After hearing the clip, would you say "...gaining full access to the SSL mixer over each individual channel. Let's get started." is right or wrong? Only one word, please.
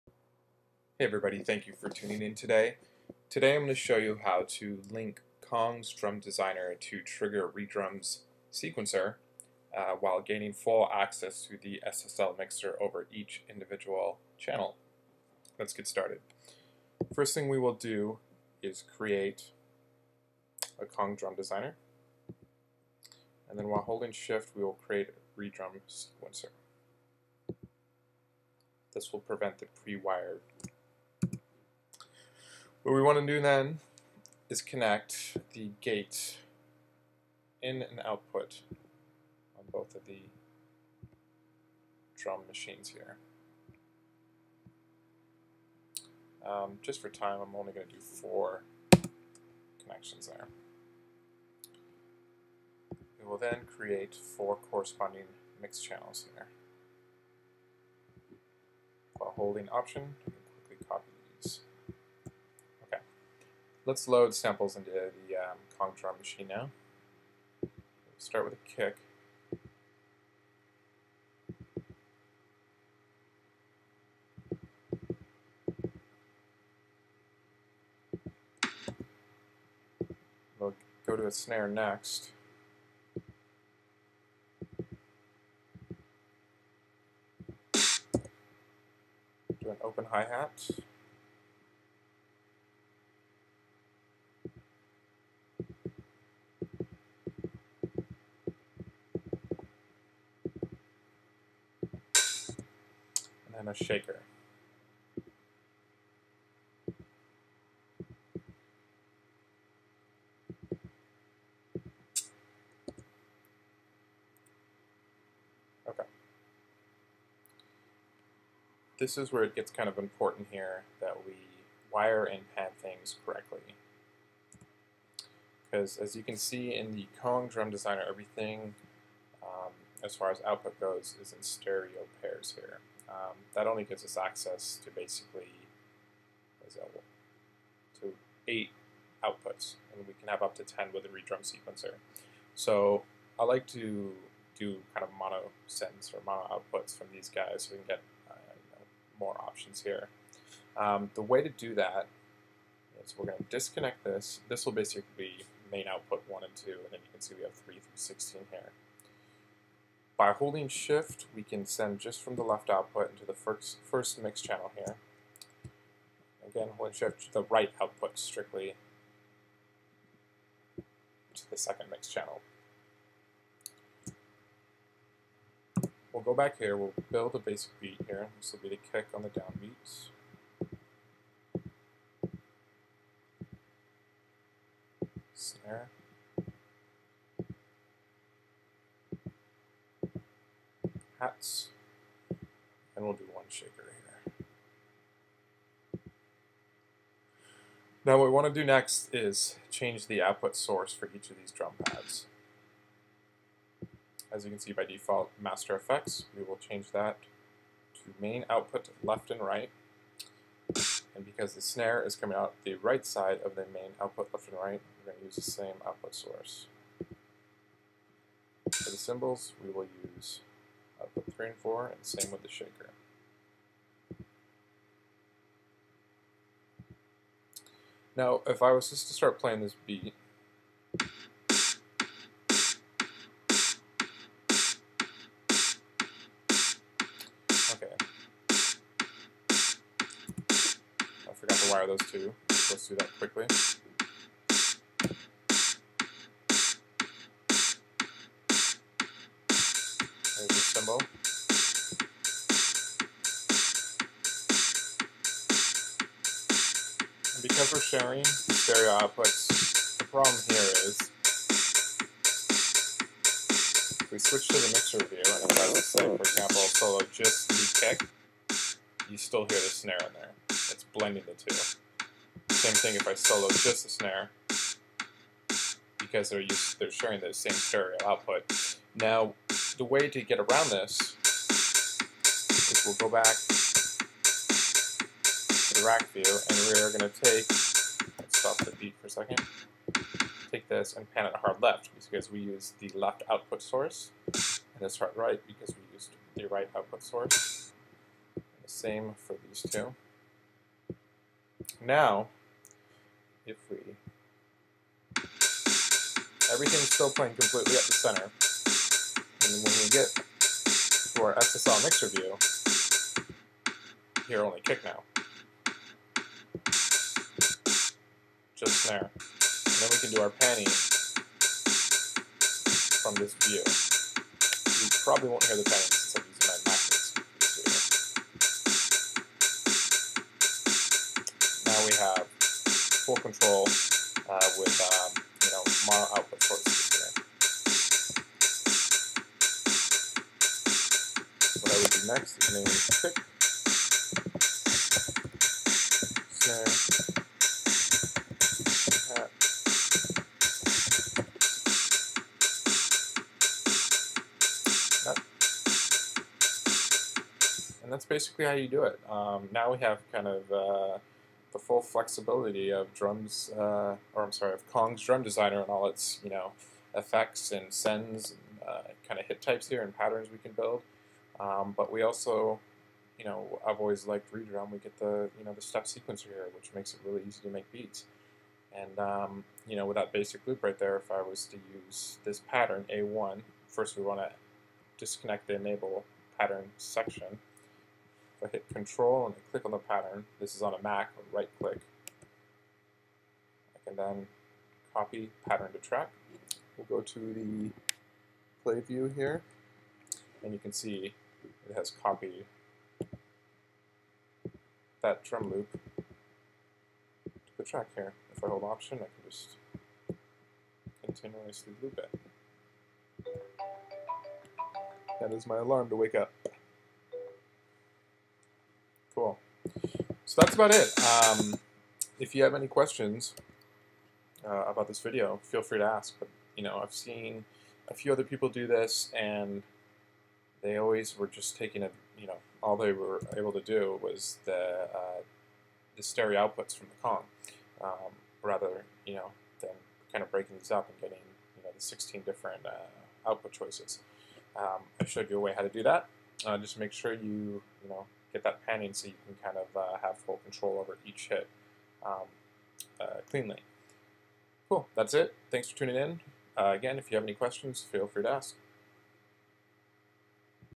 right.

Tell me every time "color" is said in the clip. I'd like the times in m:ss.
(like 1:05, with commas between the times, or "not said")
not said.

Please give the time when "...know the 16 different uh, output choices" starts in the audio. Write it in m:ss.
7:21.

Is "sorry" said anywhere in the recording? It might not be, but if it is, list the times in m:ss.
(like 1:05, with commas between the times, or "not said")
6:04.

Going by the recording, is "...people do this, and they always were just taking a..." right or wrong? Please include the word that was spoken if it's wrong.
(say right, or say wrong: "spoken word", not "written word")
right.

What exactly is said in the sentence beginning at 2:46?
Again, holding shift to the right output strictly to the second mix channel.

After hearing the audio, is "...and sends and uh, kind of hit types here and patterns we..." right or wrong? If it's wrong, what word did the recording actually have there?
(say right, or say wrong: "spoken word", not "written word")
right.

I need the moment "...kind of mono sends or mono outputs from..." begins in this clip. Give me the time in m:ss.
2:24.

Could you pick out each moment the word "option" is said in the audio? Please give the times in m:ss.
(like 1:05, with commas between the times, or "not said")
0:59, 2:29, 6:48.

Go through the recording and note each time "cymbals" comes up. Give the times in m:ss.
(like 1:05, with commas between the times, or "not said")
3:38.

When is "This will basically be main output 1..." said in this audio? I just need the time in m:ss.
2:34.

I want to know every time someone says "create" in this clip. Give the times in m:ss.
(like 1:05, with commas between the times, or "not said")
0:18, 0:24, 0:53.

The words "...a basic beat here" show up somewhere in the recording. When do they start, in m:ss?
2:57.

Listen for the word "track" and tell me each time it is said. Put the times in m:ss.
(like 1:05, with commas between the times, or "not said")
6:35, 6:47.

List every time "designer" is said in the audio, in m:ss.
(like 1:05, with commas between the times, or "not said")
0:06, 0:21, 2:07, 6:05.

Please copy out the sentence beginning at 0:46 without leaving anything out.
Um, just for time, I'm only going to do four connections there.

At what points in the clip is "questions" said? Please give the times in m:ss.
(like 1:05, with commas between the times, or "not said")
7:02, 7:37.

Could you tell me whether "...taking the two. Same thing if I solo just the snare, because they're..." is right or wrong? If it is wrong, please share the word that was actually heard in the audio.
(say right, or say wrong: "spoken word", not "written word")
wrong: "blending", not "taking".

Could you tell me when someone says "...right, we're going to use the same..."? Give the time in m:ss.
3:34.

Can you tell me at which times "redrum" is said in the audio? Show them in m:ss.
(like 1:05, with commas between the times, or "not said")
0:07, 0:25, 6:14.